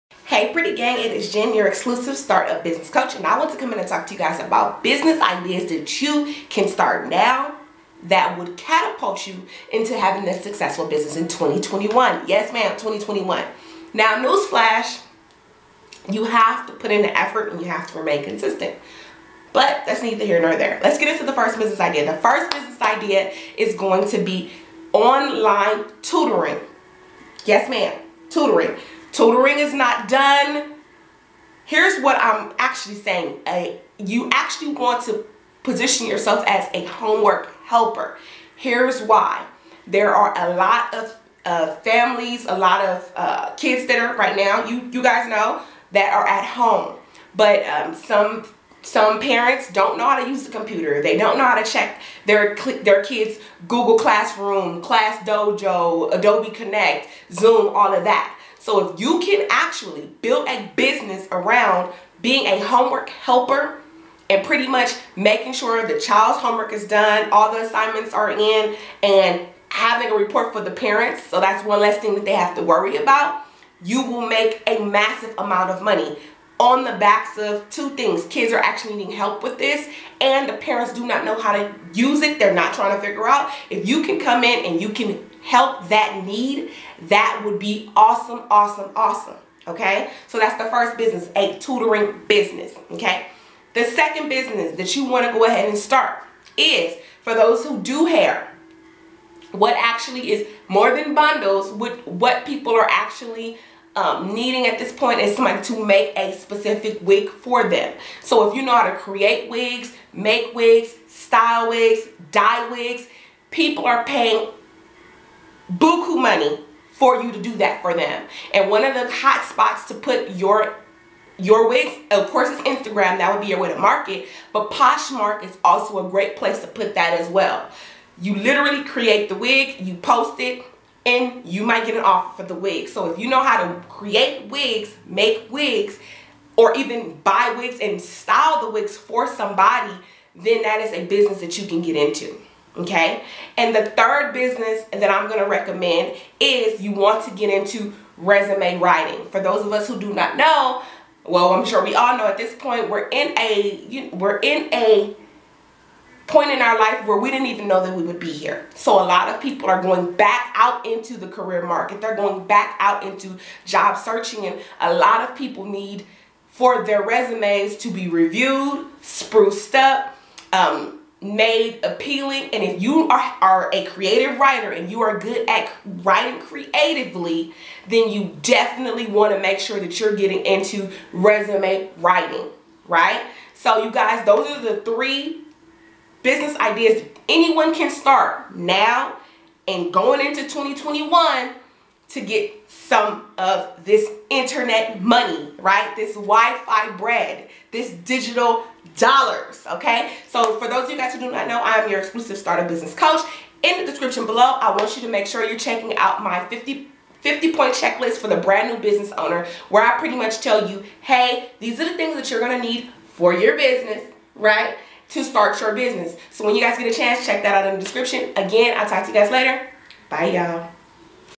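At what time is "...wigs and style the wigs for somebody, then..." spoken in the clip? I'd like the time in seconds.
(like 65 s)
137 s.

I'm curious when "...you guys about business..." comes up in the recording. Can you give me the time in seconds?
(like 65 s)
4 s.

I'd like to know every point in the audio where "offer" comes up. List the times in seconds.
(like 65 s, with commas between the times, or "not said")
132 s.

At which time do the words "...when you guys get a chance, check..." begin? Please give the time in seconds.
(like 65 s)
216 s.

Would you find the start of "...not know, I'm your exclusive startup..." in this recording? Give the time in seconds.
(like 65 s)
201 s.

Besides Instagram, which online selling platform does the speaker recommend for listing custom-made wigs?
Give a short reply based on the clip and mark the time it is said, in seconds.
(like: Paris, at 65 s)
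Poshmark, at 124 s.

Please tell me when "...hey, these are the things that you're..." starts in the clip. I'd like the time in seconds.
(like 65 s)
211 s.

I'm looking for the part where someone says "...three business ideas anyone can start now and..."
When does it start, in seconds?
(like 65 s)
184 s.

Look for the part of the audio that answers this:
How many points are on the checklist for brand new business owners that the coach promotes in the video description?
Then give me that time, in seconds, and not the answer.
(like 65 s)
207 s.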